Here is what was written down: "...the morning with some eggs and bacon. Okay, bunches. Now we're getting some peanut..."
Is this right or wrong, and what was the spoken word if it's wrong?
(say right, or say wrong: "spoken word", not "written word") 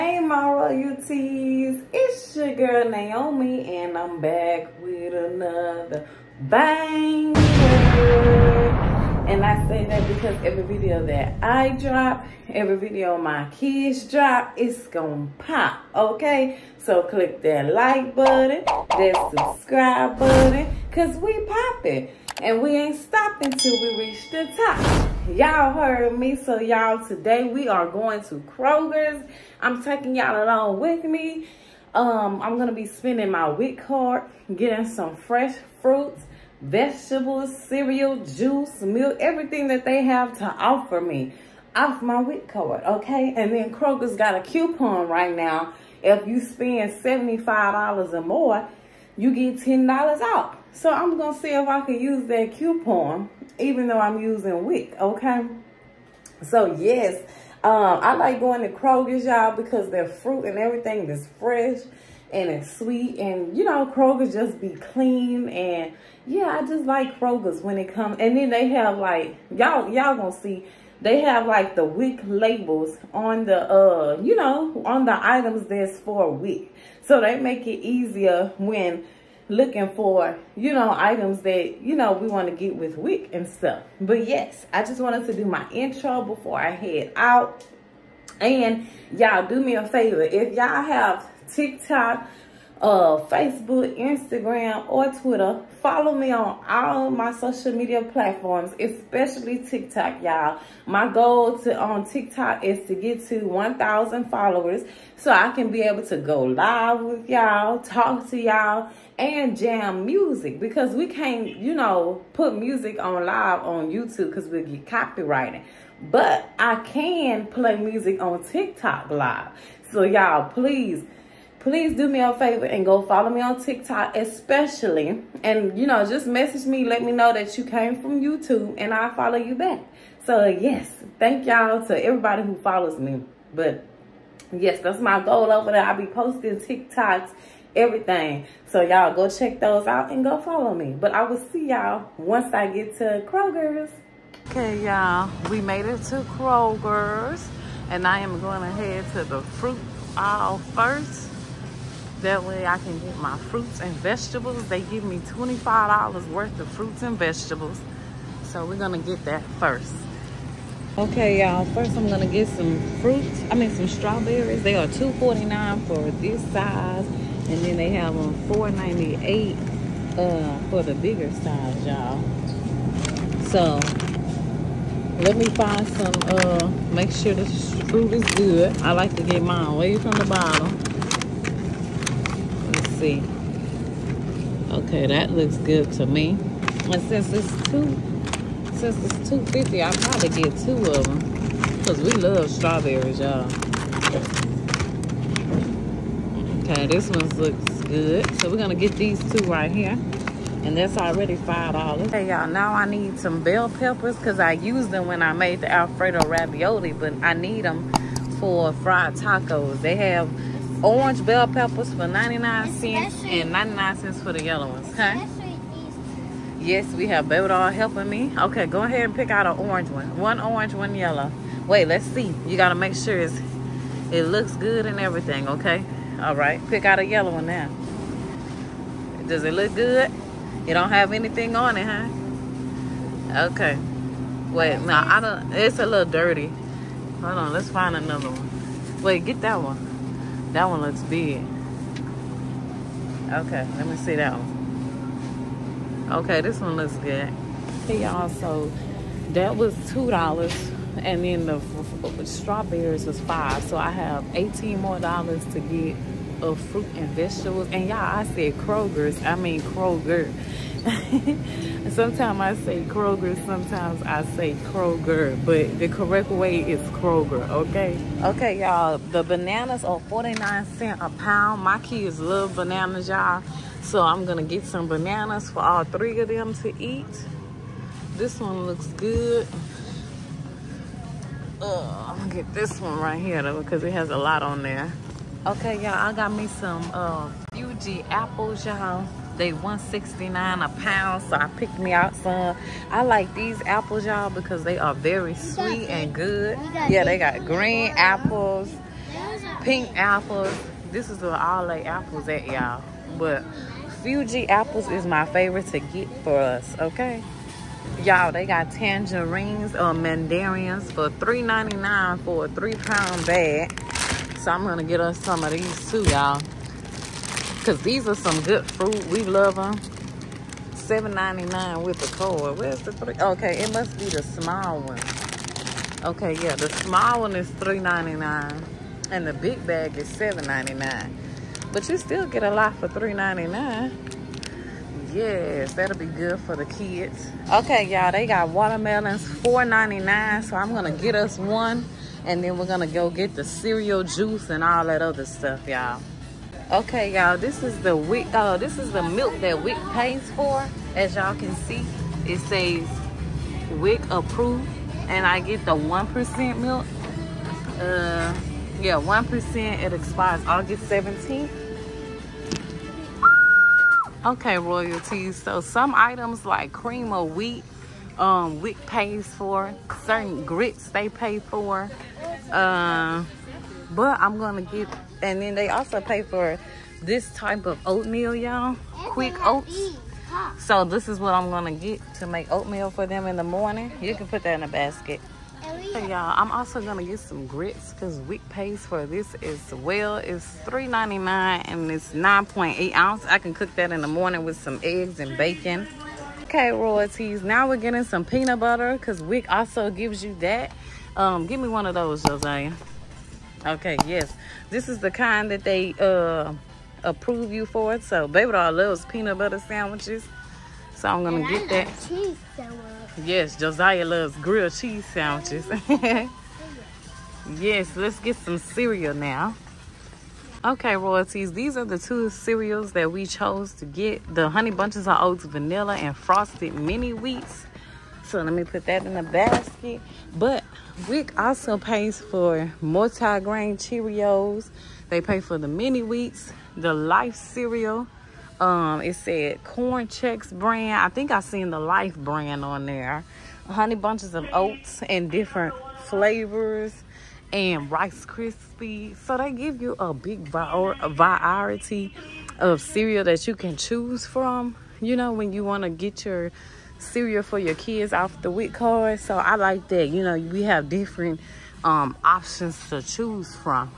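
wrong: "royalties", not "bunches".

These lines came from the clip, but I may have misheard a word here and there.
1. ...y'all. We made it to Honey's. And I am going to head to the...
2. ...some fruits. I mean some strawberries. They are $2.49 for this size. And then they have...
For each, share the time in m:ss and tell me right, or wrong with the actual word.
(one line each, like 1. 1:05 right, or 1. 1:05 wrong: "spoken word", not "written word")
1. 2:24 wrong: "Kroger", not "Honey"
2. 2:42 right.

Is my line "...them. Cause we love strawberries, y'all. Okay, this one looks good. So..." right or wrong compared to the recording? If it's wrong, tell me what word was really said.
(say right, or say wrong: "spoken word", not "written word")
right.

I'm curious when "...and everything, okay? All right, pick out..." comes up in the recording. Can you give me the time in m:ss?
3:44.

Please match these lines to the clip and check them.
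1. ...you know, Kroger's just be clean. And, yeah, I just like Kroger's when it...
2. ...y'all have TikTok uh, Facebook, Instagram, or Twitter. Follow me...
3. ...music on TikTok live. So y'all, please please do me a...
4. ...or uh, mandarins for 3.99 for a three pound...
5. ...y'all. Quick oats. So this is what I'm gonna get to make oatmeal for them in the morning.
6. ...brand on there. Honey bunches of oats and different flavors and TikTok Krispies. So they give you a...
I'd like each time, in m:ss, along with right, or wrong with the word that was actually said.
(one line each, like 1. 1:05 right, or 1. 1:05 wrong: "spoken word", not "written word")
1. 1:03 right
2. 1:30 right
3. 1:57 right
4. 5:09 right
5. 6:18 right
6. 7:22 wrong: "Rice", not "TikTok".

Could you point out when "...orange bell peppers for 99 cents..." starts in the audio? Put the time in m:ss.
3:30.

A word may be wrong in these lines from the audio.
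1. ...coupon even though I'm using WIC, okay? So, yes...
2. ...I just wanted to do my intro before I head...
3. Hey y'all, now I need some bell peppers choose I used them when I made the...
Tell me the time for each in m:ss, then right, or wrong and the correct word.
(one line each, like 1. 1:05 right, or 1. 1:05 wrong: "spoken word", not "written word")
1. 0:52 right
2. 1:24 right
3. 3:22 wrong: "cause", not "choose".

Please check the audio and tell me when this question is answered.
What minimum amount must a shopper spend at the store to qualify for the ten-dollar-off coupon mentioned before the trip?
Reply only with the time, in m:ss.
0:47.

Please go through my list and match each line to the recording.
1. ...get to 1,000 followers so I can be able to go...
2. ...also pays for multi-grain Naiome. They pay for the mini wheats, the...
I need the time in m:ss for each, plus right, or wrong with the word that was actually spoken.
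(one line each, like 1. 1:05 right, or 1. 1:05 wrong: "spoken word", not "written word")
1. 1:42 right
2. 7:11 wrong: "Cheerios", not "Naiome".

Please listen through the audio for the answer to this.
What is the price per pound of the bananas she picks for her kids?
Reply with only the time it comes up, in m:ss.
4:30.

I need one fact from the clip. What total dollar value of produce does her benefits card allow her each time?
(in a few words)
$25.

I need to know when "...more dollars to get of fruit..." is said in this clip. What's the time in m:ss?
4:14.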